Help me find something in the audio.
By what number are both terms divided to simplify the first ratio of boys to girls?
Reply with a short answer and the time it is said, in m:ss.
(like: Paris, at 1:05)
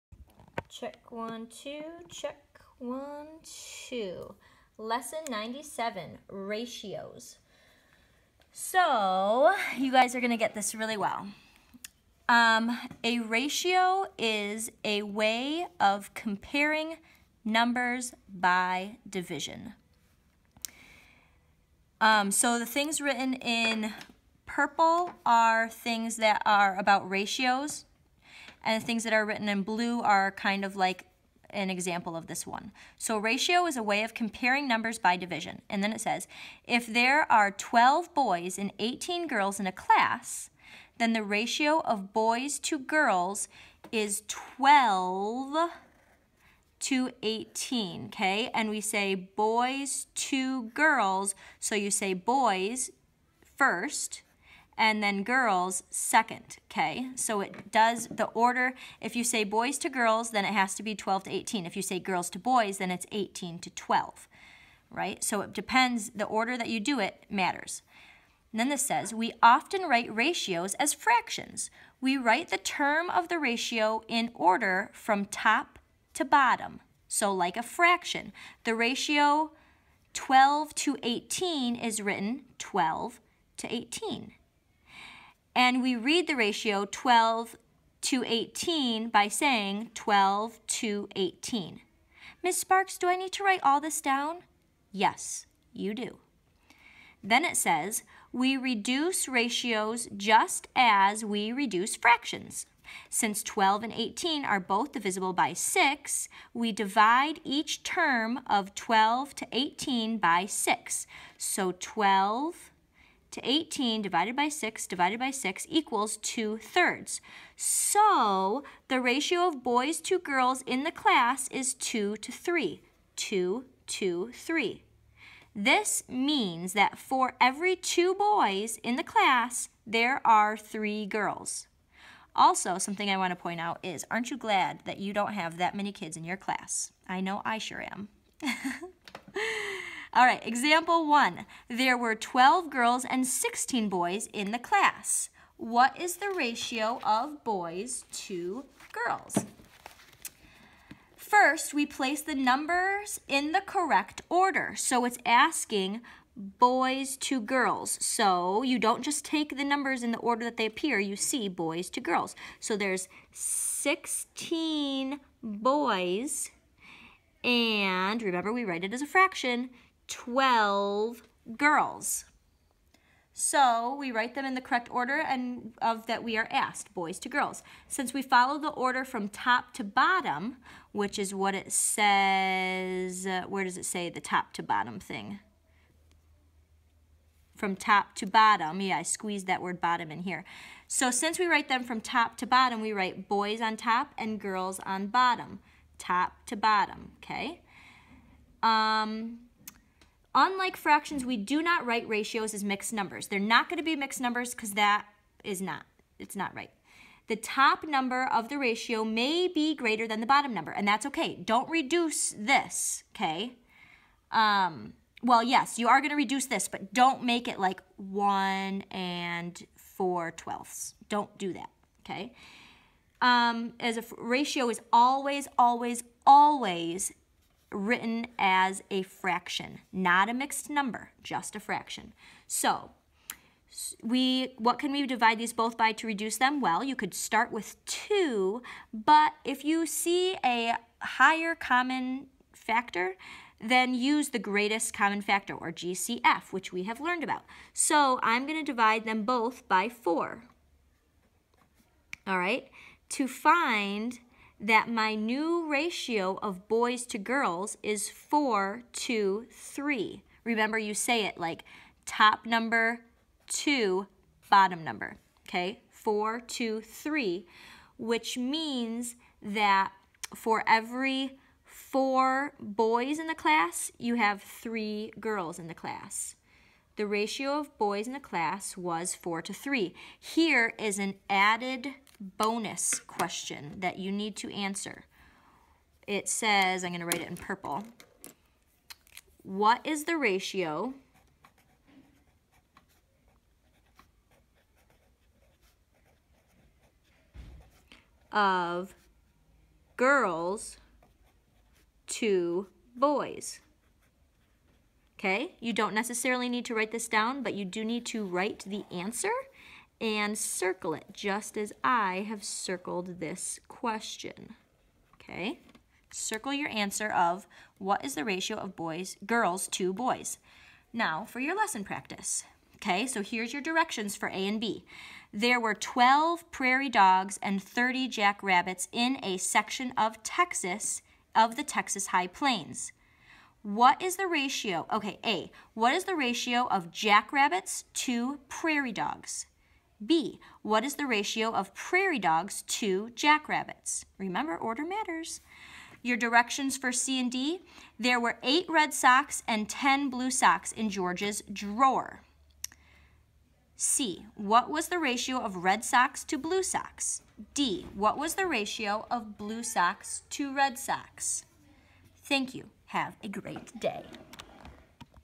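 6, at 1:44.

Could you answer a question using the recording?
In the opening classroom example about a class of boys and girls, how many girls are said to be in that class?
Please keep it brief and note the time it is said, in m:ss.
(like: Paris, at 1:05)
18, at 0:38.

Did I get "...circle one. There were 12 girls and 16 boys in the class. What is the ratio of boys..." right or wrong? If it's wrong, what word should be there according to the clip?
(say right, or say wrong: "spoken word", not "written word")
wrong: "example", not "circle".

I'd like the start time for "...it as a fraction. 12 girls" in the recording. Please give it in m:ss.
2:48.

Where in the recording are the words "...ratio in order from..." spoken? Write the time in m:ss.
1:13.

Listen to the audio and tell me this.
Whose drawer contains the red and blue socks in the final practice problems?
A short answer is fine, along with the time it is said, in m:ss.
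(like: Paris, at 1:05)
George's, at 5:50.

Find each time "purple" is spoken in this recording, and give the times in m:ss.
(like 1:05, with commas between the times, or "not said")
0:24, 4:47.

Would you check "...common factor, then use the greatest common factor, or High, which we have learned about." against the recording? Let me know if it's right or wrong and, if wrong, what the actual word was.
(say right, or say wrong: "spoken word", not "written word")
wrong: "GCF", not "High".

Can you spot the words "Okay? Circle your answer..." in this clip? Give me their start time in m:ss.
5:15.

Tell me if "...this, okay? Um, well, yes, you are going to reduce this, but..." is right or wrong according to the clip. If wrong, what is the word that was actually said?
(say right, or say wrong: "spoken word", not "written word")
right.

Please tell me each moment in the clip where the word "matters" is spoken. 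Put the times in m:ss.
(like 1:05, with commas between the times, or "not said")
1:07, 5:44.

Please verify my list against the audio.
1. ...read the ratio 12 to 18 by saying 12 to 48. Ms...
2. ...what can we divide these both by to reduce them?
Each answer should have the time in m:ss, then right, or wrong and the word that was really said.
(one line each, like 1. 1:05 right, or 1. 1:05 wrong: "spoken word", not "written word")
1. 1:25 wrong: "18", not "48"
2. 3:54 right.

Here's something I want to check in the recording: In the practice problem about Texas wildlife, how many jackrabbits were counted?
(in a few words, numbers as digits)
30.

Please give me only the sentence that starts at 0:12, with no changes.
Um, a ratio is a way of comparing numbers by division.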